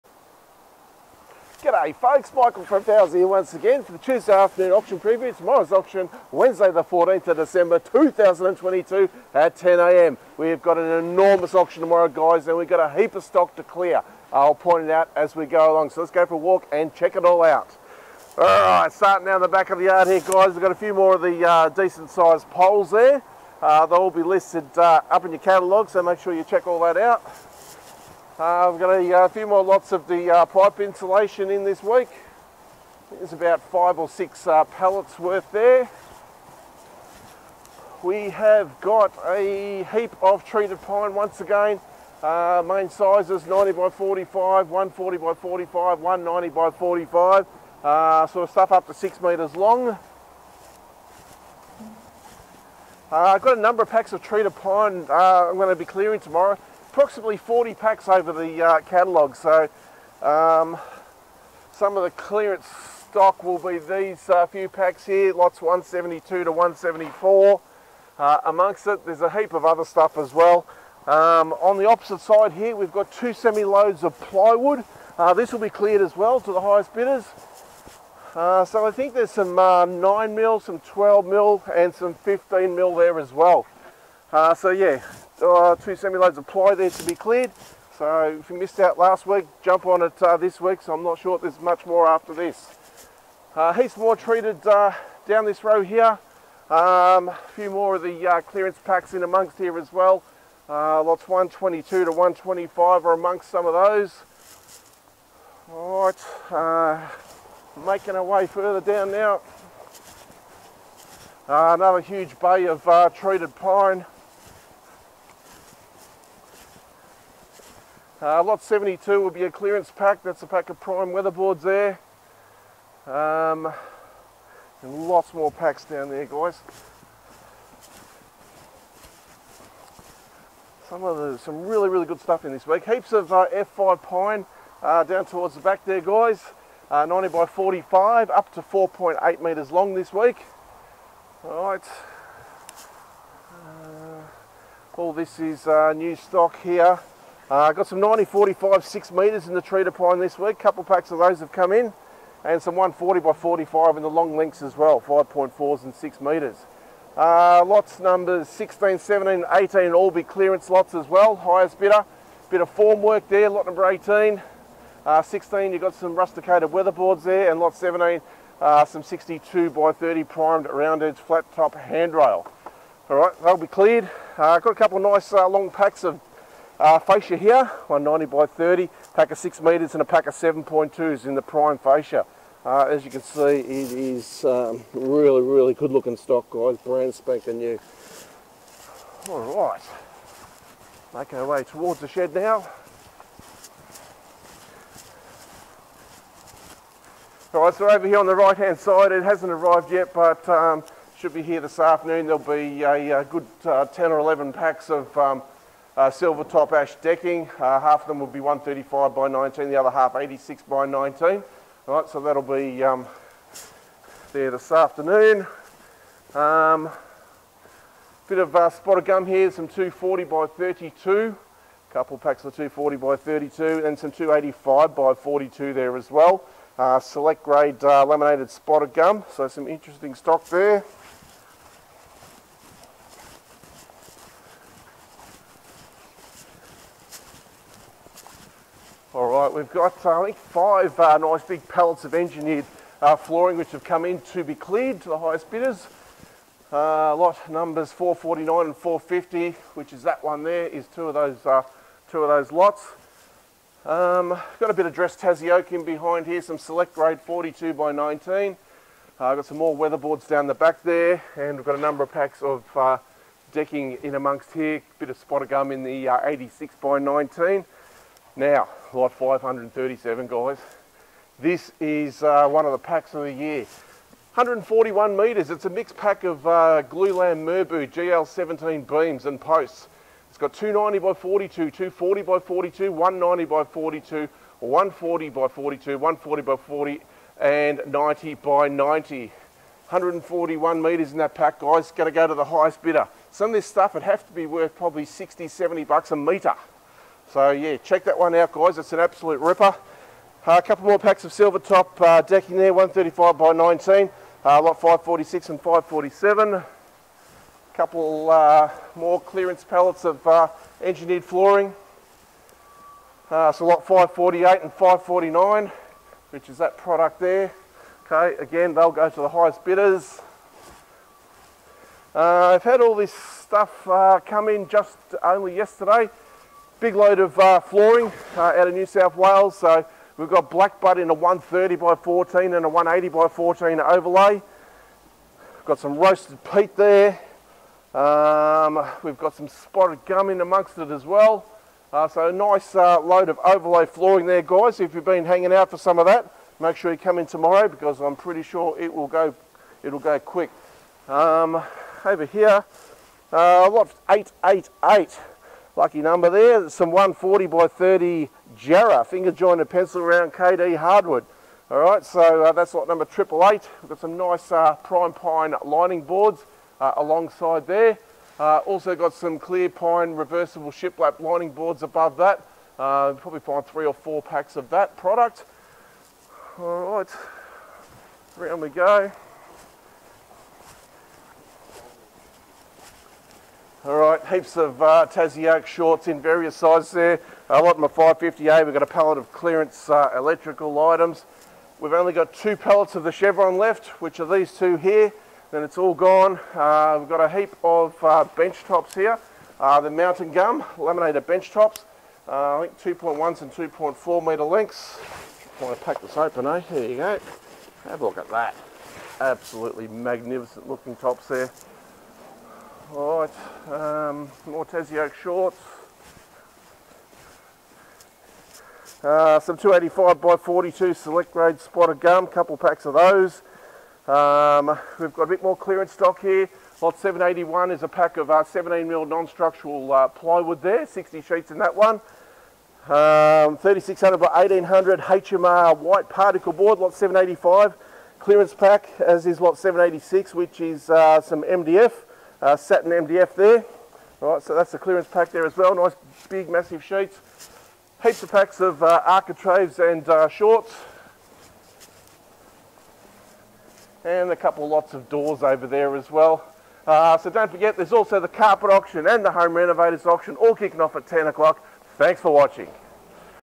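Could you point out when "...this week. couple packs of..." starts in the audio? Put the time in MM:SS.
02:30.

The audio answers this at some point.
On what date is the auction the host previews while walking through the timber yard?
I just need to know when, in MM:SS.
00:06.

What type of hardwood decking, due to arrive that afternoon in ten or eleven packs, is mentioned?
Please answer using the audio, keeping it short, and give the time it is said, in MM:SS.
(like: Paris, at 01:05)
Silver top ash, at 03:26.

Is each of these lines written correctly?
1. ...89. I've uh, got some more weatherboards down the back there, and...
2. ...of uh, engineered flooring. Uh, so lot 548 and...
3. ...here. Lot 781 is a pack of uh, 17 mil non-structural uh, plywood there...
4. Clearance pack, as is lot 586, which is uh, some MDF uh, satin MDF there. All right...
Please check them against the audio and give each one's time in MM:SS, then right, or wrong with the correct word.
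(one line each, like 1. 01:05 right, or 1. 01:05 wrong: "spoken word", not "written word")
1. 04:17 wrong: "19", not "89"
2. 05:10 right
3. 07:06 right
4. 07:18 wrong: "786", not "586".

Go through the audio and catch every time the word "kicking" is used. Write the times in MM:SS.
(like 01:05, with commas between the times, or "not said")
07:40.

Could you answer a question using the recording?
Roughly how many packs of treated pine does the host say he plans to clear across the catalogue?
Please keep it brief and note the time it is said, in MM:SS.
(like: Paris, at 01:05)
40, at 00:56.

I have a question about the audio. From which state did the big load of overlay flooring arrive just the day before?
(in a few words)
New South Wales.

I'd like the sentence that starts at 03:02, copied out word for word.
Uh, as you can see, it is um, really, really good looking stock, guys.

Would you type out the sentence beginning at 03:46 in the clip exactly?
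Uh, select grade uh, laminated spotted gum, so some interesting stock there.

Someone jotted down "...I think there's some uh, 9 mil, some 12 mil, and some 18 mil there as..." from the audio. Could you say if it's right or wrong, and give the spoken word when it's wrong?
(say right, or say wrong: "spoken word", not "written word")
wrong: "15", not "18".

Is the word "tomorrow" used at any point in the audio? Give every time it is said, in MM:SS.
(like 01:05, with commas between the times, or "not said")
00:05, 00:11, 00:56, 05:47.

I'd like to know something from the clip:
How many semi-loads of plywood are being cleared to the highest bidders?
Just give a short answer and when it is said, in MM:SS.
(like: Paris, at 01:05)
2, at 01:13.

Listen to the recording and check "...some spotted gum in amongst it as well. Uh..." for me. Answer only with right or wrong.
right.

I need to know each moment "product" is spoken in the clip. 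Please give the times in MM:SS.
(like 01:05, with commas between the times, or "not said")
05:16, 06:14.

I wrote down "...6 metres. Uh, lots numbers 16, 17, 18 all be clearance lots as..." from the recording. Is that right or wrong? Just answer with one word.
right.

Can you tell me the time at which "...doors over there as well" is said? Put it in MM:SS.
07:35.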